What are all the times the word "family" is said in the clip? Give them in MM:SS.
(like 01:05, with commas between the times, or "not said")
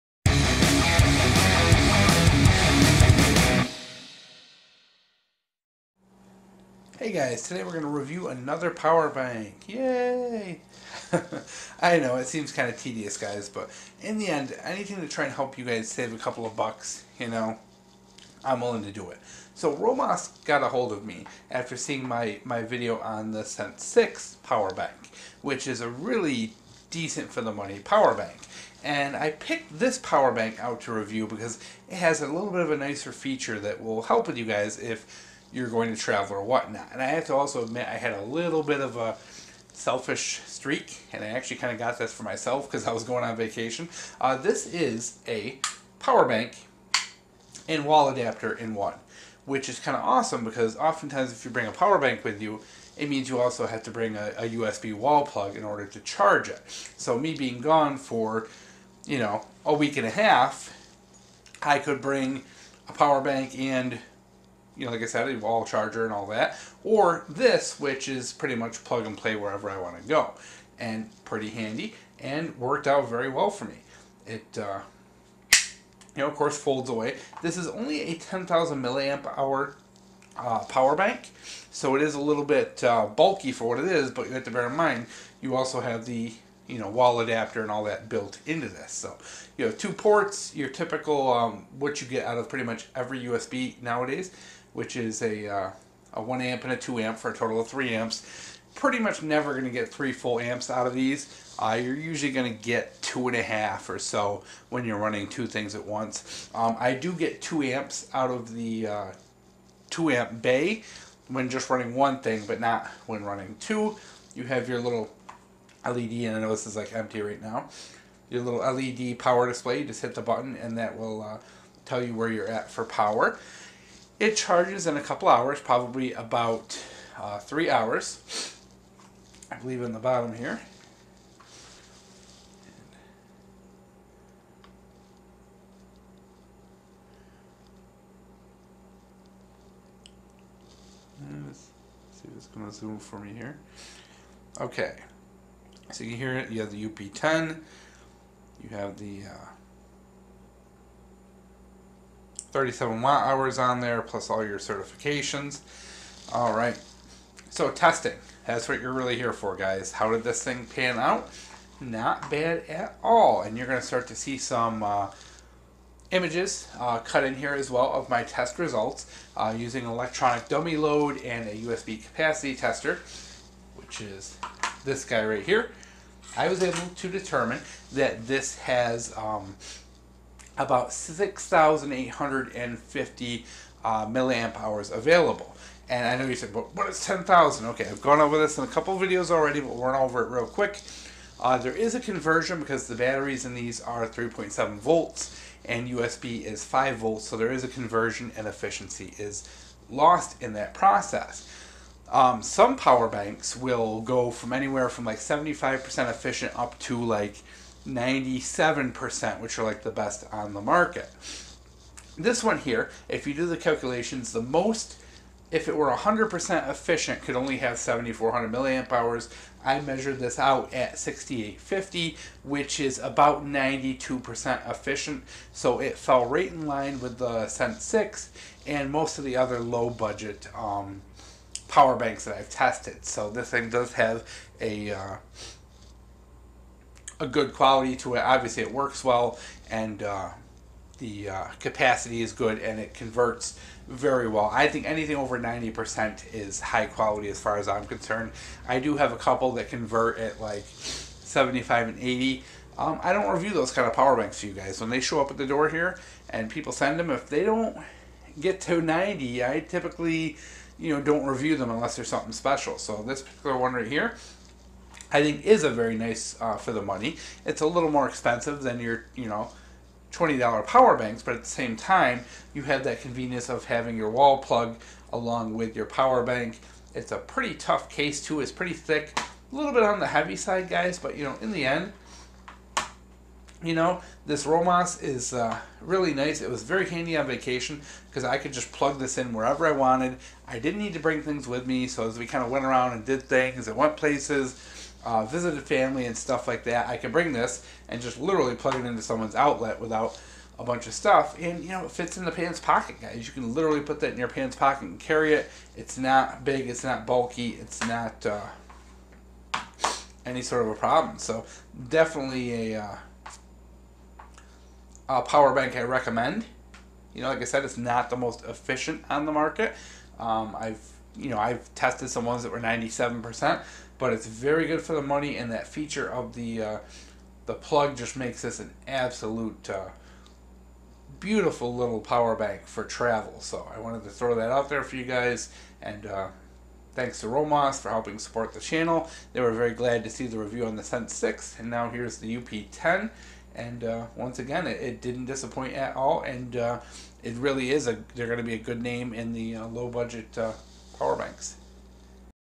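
04:55.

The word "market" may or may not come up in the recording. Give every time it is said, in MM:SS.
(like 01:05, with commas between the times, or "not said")
03:30, 05:19.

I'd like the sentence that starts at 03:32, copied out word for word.
This one here, if you do the calculations, the most, if it were 100% efficient, could only have 7,400 milliamp hours.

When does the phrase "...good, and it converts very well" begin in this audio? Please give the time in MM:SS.
04:02.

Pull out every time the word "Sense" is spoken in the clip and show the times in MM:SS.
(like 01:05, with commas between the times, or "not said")
00:23, 03:47, 05:40.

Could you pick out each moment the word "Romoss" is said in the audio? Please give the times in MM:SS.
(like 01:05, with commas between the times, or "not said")
00:19, 04:44, 05:37.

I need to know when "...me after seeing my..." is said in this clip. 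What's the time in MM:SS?
00:21.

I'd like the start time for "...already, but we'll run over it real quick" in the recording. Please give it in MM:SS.
03:09.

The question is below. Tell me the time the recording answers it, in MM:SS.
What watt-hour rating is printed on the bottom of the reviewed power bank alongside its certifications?
02:32.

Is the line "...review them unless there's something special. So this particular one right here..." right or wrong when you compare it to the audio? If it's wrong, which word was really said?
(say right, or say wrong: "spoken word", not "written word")
right.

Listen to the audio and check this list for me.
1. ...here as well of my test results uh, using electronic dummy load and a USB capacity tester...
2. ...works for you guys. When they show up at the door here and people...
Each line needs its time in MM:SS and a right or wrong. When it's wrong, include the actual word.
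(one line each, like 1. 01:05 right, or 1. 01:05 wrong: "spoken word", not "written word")
1. 02:47 right
2. 04:14 wrong: "banks", not "works".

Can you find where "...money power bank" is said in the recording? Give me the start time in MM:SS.
00:27.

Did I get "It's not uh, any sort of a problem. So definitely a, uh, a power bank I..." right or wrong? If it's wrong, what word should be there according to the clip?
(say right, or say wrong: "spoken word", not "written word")
right.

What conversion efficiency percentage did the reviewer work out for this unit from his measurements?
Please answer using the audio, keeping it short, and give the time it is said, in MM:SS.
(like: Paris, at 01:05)
92%, at 03:43.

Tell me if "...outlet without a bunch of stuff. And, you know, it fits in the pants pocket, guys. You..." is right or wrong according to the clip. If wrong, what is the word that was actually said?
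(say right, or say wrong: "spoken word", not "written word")
right.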